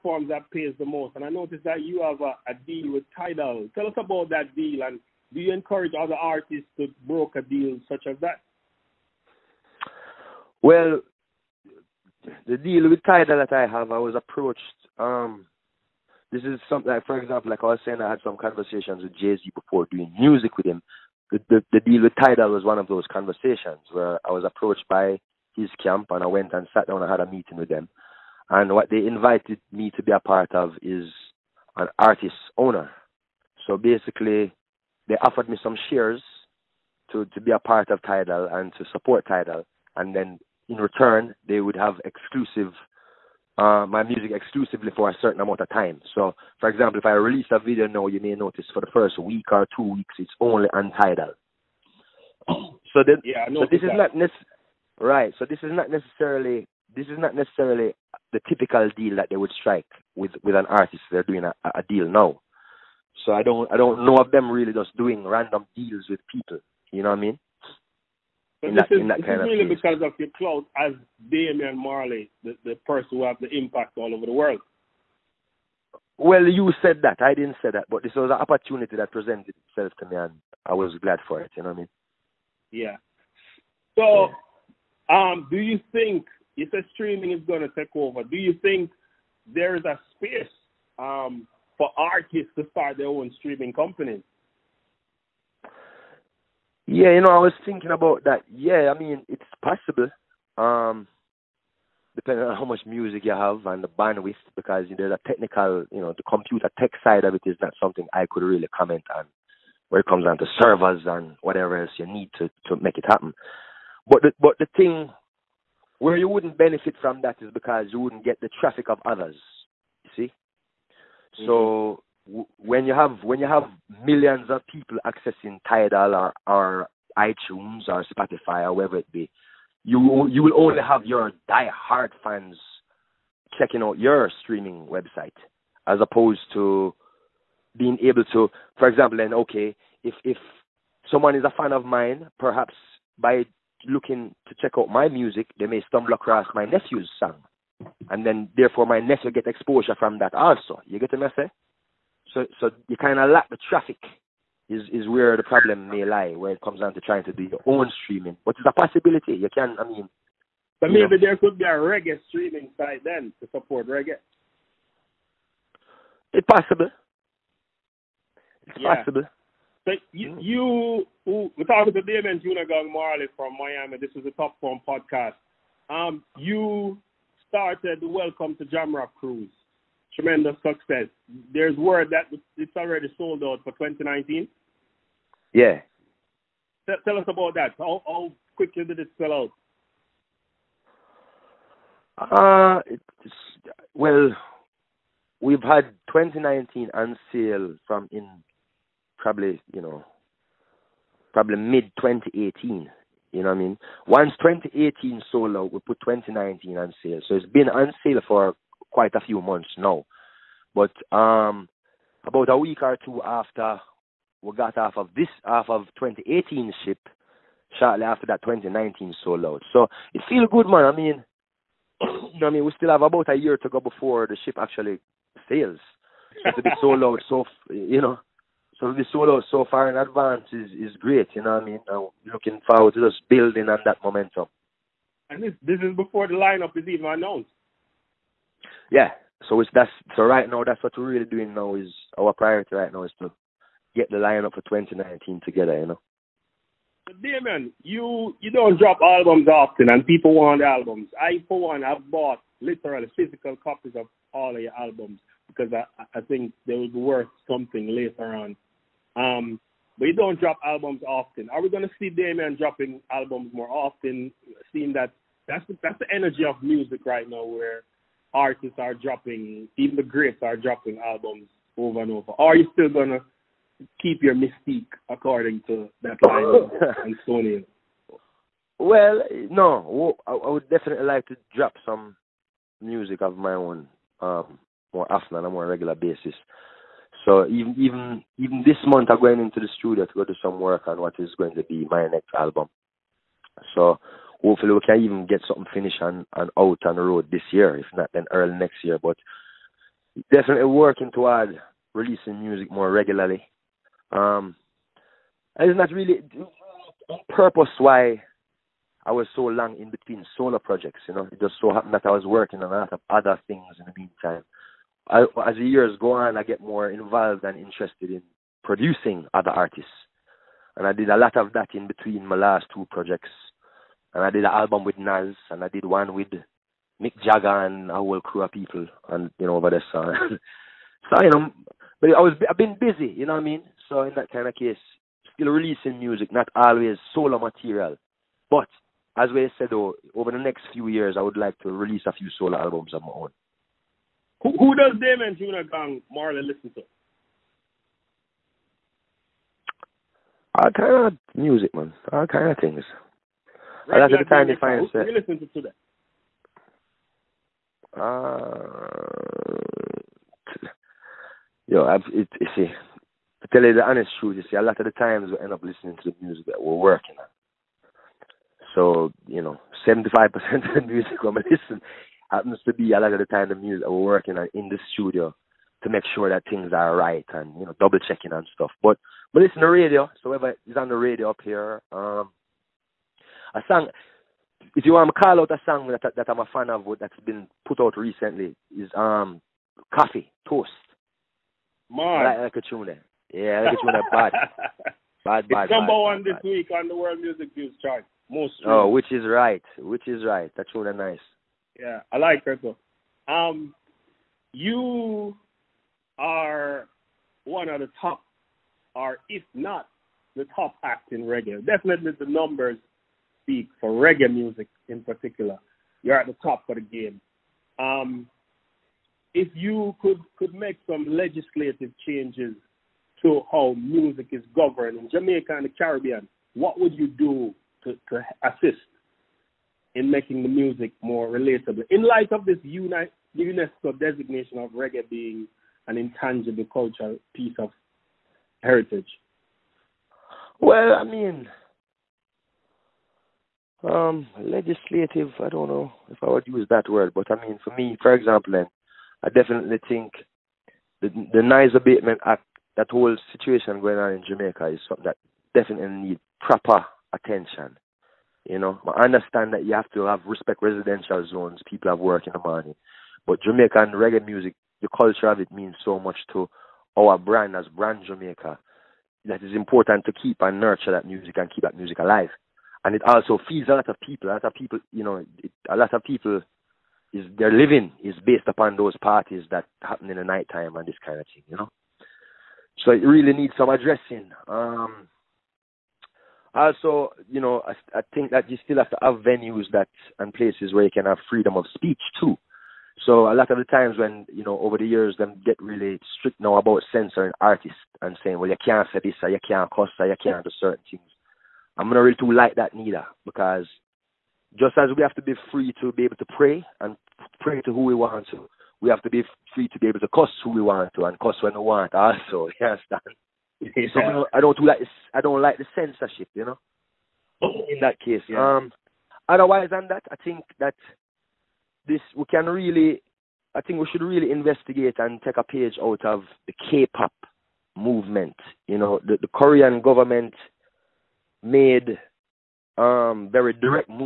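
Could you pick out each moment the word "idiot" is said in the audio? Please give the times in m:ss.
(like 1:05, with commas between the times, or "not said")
not said.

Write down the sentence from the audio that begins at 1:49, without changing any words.
Where it comes down to servers and whatever else you need to to make it happen.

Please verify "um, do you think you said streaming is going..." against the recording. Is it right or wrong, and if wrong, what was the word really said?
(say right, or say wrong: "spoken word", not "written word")
right.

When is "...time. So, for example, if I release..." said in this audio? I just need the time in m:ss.
0:45.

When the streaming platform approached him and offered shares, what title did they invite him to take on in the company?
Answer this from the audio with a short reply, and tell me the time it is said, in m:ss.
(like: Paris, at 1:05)
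Artist owner, at 0:31.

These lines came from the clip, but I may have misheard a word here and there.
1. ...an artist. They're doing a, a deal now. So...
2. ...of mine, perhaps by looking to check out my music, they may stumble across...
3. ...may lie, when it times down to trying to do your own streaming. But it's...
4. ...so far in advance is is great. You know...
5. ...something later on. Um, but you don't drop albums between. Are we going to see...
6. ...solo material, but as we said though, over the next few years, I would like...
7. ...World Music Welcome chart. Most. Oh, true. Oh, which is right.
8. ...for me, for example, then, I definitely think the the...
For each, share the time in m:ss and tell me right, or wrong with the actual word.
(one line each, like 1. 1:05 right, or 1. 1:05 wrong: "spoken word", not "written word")
1. 1:00 right
2. 2:21 right
3. 2:35 wrong: "comes", not "times"
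4. 3:49 right
5. 4:17 wrong: "often", not "between"
6. 5:37 right
7. 6:36 wrong: "Views", not "Welcome"
8. 7:27 right.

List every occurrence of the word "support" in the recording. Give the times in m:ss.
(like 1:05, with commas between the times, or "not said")
0:38, 2:43.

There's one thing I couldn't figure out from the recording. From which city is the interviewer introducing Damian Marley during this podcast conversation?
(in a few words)
Miami.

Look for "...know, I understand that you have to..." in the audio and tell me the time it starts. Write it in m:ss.
7:38.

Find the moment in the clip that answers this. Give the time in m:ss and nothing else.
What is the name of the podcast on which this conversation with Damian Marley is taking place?
2:54.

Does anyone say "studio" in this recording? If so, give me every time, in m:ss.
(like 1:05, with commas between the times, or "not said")
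4:49, 6:14.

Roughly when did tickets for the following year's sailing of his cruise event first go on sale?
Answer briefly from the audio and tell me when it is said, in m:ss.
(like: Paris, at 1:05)
Mid 2018, at 3:21.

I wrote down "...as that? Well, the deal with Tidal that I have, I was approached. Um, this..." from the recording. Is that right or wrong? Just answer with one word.
right.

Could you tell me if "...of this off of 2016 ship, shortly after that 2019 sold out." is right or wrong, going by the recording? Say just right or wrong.
wrong.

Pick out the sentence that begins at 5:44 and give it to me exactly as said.
Who, who does Damian Junior Gong Marley listen to?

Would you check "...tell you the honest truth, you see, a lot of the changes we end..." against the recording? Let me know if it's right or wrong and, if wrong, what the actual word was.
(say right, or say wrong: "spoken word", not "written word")
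wrong: "times", not "changes".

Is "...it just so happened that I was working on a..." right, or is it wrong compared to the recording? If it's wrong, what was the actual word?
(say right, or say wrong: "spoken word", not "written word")
right.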